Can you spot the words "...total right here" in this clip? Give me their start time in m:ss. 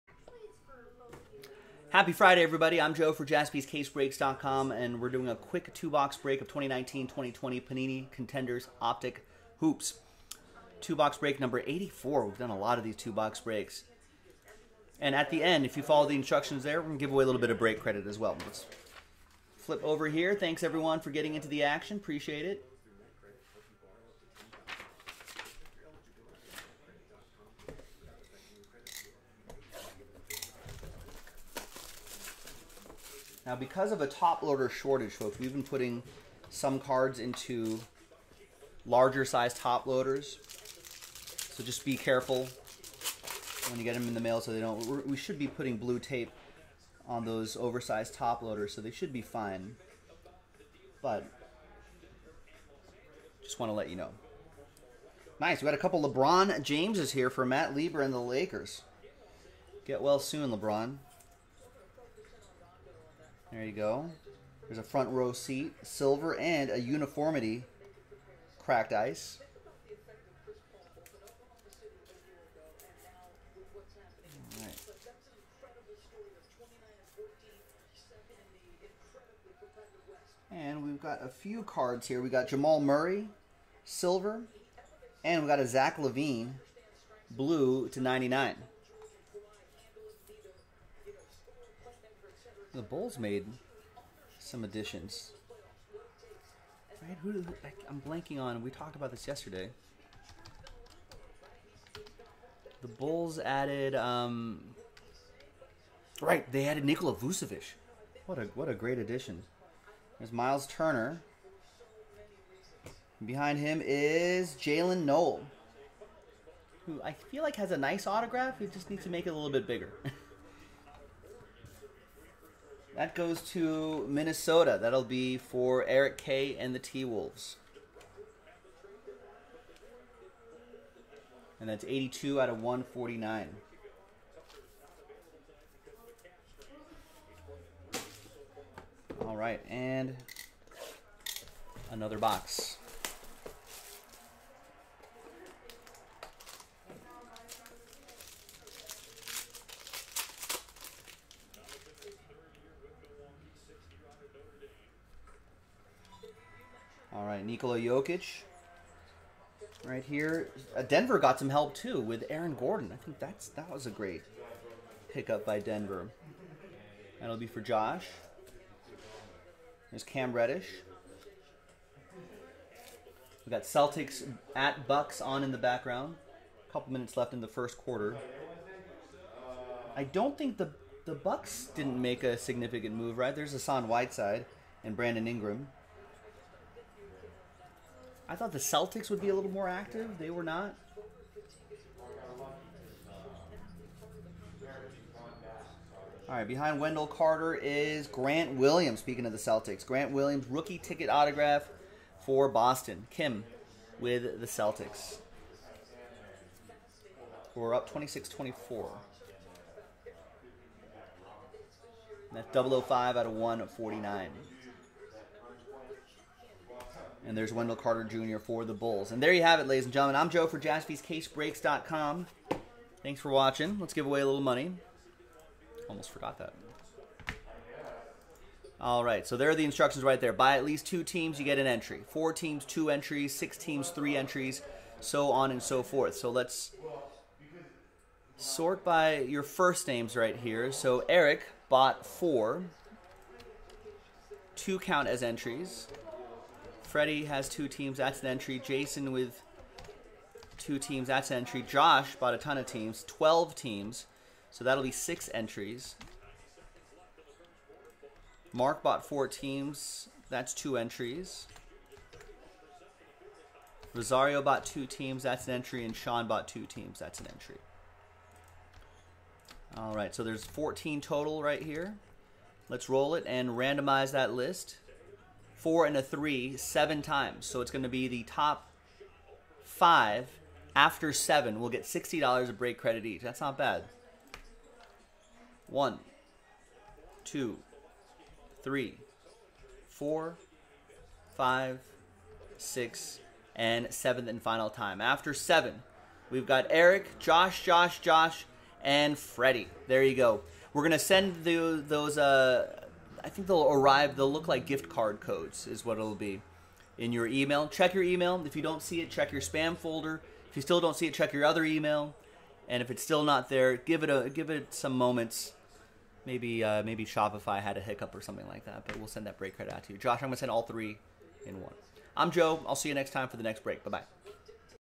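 4:30.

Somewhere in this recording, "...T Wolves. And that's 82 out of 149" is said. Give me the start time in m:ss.
2:06.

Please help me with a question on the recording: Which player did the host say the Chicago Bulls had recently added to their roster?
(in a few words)
Nikola Vucevic.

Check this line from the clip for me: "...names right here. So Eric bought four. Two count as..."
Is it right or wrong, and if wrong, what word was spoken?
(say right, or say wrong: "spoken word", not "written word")
right.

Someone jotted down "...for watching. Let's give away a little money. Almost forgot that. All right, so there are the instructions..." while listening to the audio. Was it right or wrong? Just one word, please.
right.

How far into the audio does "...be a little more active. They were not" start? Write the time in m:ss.
3:09.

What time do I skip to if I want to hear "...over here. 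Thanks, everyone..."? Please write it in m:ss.
0:19.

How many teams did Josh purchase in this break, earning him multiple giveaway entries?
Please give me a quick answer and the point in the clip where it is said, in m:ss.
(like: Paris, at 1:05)
12, at 4:13.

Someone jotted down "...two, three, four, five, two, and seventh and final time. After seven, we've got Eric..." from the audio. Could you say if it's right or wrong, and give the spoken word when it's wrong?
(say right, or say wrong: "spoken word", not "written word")
wrong: "six", not "two".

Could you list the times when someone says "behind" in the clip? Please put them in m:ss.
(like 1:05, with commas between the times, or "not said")
1:53, 3:16.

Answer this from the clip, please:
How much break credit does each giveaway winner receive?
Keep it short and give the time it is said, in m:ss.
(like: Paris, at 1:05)
$60, at 4:41.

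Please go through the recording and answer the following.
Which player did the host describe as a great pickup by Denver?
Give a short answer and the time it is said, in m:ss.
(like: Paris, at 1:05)
Aaron Gordon, at 2:42.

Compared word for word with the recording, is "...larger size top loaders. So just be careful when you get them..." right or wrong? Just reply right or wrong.
right.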